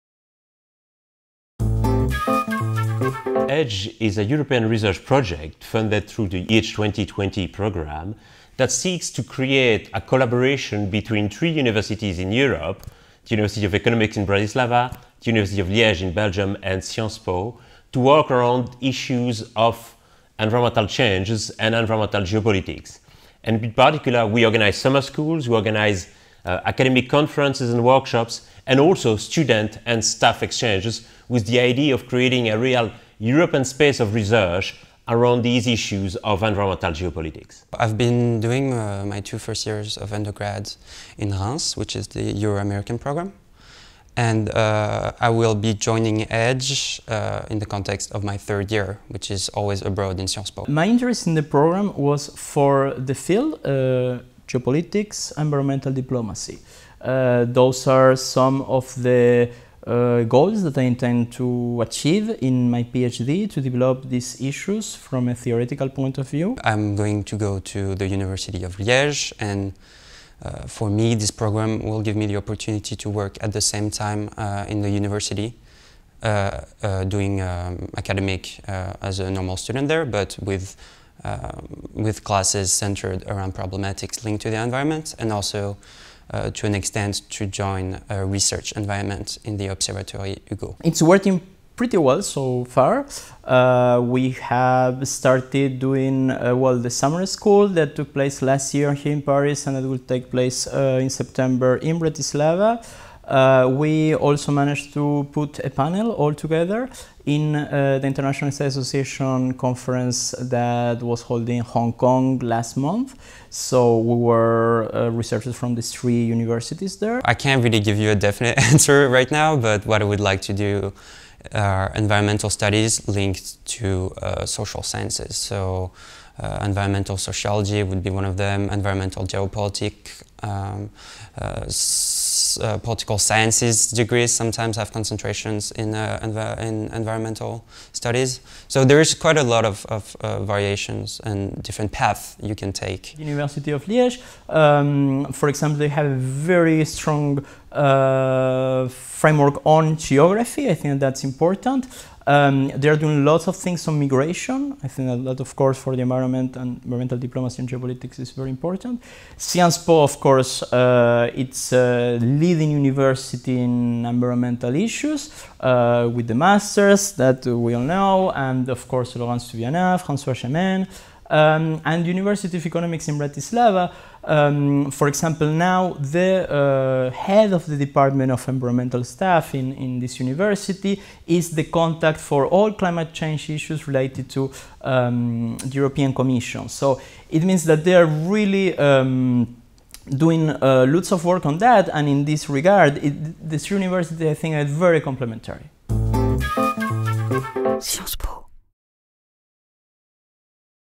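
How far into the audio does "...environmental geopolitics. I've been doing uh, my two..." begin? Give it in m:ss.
0:36.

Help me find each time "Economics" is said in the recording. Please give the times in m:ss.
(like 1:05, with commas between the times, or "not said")
0:13, 2:52.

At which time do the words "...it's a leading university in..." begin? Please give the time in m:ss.
2:41.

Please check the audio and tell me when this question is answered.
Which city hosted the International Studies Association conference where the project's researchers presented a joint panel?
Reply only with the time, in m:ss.
1:51.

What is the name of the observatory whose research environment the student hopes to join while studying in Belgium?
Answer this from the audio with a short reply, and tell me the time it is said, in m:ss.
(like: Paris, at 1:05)
Hugo, at 1:30.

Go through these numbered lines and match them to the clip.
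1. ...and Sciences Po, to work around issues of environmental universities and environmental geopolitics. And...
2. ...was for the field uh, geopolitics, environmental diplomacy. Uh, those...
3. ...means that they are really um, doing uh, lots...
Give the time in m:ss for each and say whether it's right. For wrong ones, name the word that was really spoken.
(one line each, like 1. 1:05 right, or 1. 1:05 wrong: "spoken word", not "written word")
1. 0:16 wrong: "changes", not "universities"
2. 0:51 right
3. 3:07 right.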